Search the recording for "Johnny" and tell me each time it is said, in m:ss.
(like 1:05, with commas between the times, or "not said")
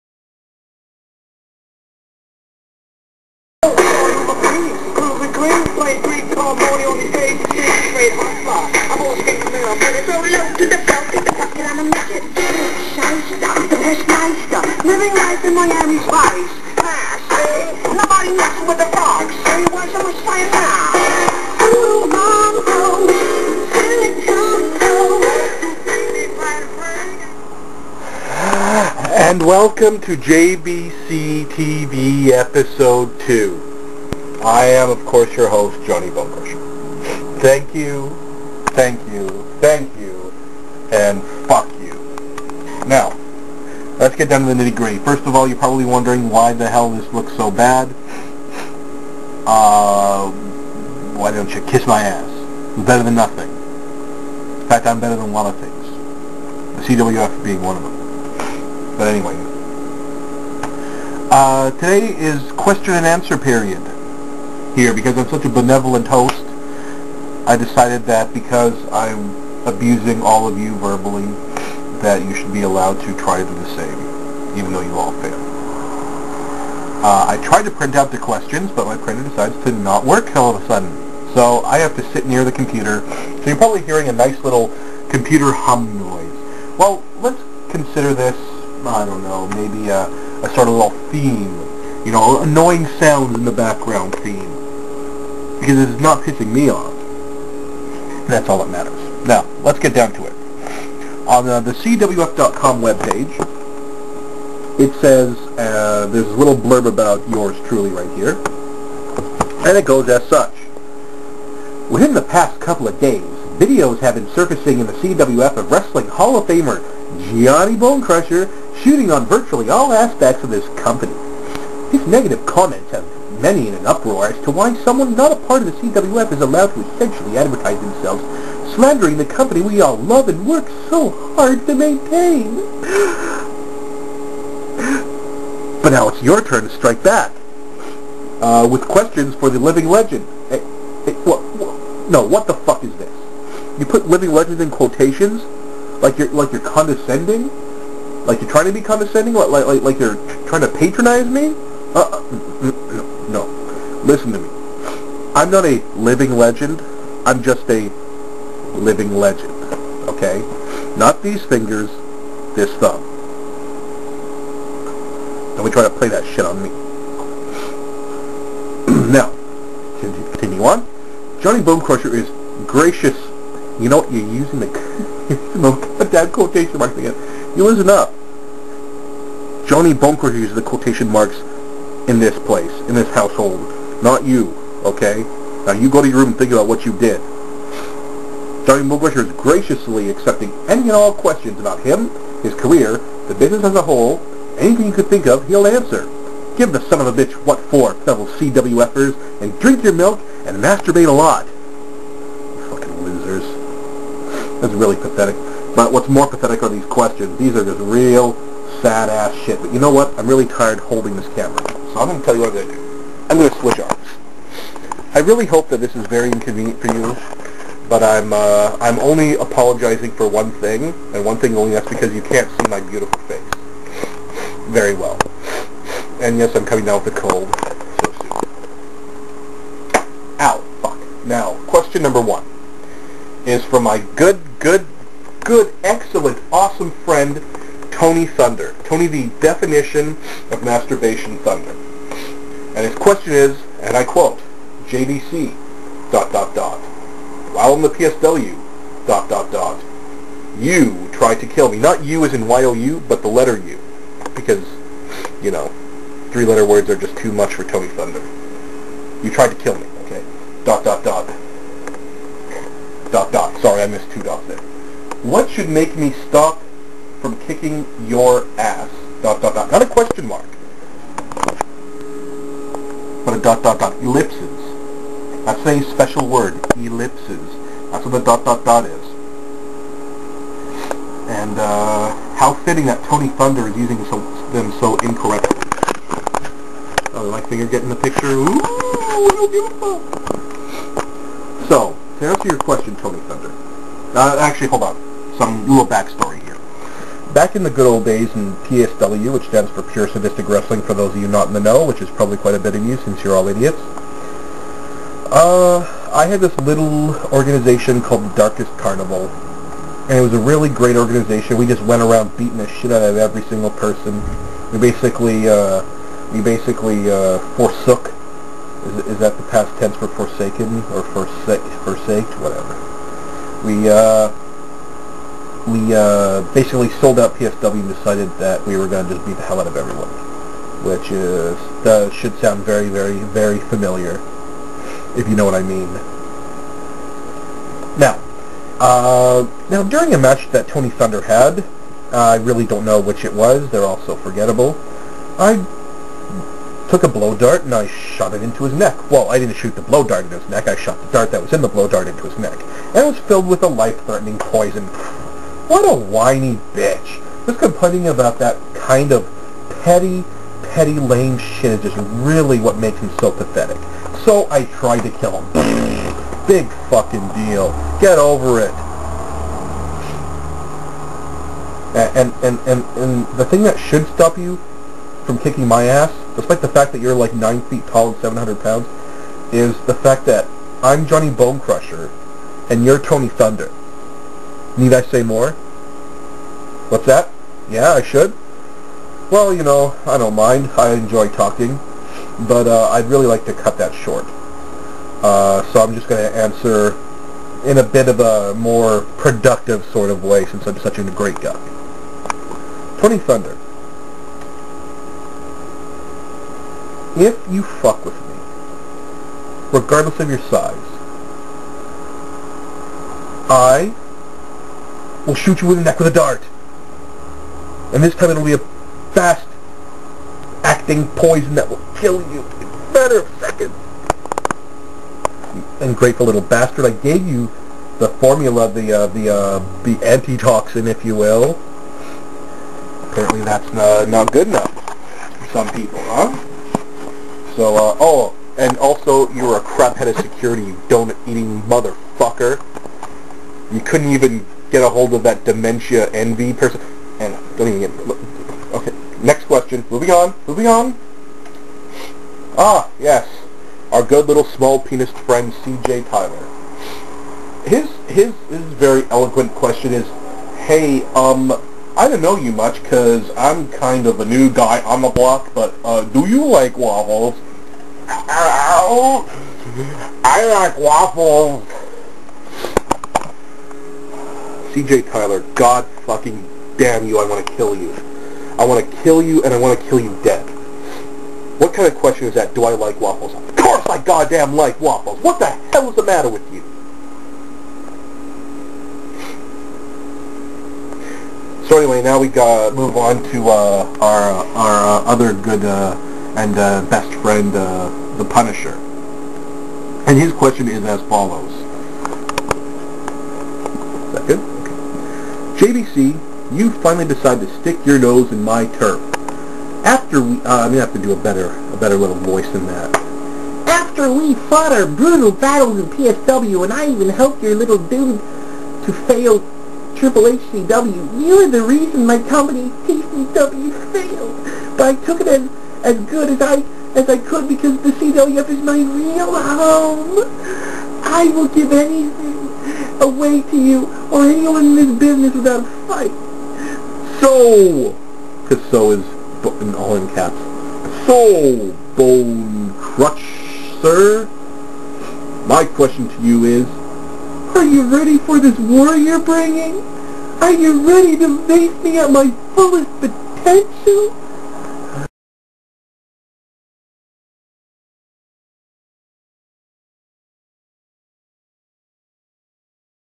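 0:35, 2:51, 2:59, 3:08, 6:21.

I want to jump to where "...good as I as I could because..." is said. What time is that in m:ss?
8:46.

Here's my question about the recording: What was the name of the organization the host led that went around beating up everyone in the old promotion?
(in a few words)
the Darkest Carnival.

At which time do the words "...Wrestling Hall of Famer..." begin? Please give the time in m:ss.
1:55.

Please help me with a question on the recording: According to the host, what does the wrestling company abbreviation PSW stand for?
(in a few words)
Pure Sadistic Wrestling.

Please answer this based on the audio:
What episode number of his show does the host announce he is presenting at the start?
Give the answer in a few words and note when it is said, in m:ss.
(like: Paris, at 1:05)
2, at 0:32.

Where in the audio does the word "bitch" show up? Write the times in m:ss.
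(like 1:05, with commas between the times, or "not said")
3:17, 5:56.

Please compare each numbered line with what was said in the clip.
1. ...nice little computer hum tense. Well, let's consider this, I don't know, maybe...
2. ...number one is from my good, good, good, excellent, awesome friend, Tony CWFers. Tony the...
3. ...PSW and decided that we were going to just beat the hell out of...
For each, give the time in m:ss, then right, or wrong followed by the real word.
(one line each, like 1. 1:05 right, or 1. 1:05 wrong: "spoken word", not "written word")
1. 1:24 wrong: "noise", not "tense"
2. 3:52 wrong: "Thunder", not "CWFers"
3. 5:27 right.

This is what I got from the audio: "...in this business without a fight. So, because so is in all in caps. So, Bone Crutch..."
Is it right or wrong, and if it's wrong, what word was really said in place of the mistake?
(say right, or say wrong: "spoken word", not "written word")
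right.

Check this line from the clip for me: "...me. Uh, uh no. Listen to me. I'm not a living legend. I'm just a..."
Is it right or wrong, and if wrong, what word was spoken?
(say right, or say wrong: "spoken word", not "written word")
right.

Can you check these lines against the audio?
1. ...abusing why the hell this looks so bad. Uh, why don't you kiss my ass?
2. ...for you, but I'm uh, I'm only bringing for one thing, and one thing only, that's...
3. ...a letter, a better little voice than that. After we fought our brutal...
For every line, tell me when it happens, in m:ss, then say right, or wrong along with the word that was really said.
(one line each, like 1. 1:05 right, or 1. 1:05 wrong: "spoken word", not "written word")
1. 0:45 wrong: "wondering", not "abusing"
2. 3:36 wrong: "apologizing", not "bringing"
3. 8:31 wrong: "better", not "letter".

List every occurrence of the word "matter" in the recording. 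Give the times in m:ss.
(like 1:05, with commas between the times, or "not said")
1:38, 7:02, 8:06.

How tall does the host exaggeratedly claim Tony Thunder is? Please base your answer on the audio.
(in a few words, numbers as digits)
9 feet.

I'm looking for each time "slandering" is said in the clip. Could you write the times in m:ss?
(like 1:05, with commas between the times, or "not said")
2:08.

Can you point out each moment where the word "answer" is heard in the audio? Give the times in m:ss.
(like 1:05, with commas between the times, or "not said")
1:03, 3:15, 4:52, 6:36.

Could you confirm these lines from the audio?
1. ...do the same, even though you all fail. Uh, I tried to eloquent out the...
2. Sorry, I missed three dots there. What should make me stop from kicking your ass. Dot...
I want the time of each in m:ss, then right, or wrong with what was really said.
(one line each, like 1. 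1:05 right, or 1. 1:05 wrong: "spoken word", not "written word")
1. 1:13 wrong: "print", not "eloquent"
2. 4:23 wrong: "two", not "three".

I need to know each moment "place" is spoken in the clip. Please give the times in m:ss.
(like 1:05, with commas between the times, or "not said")
3:02.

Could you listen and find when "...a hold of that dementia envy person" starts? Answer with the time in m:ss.
7:24.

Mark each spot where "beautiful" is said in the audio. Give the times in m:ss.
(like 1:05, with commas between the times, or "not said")
3:42, 4:49.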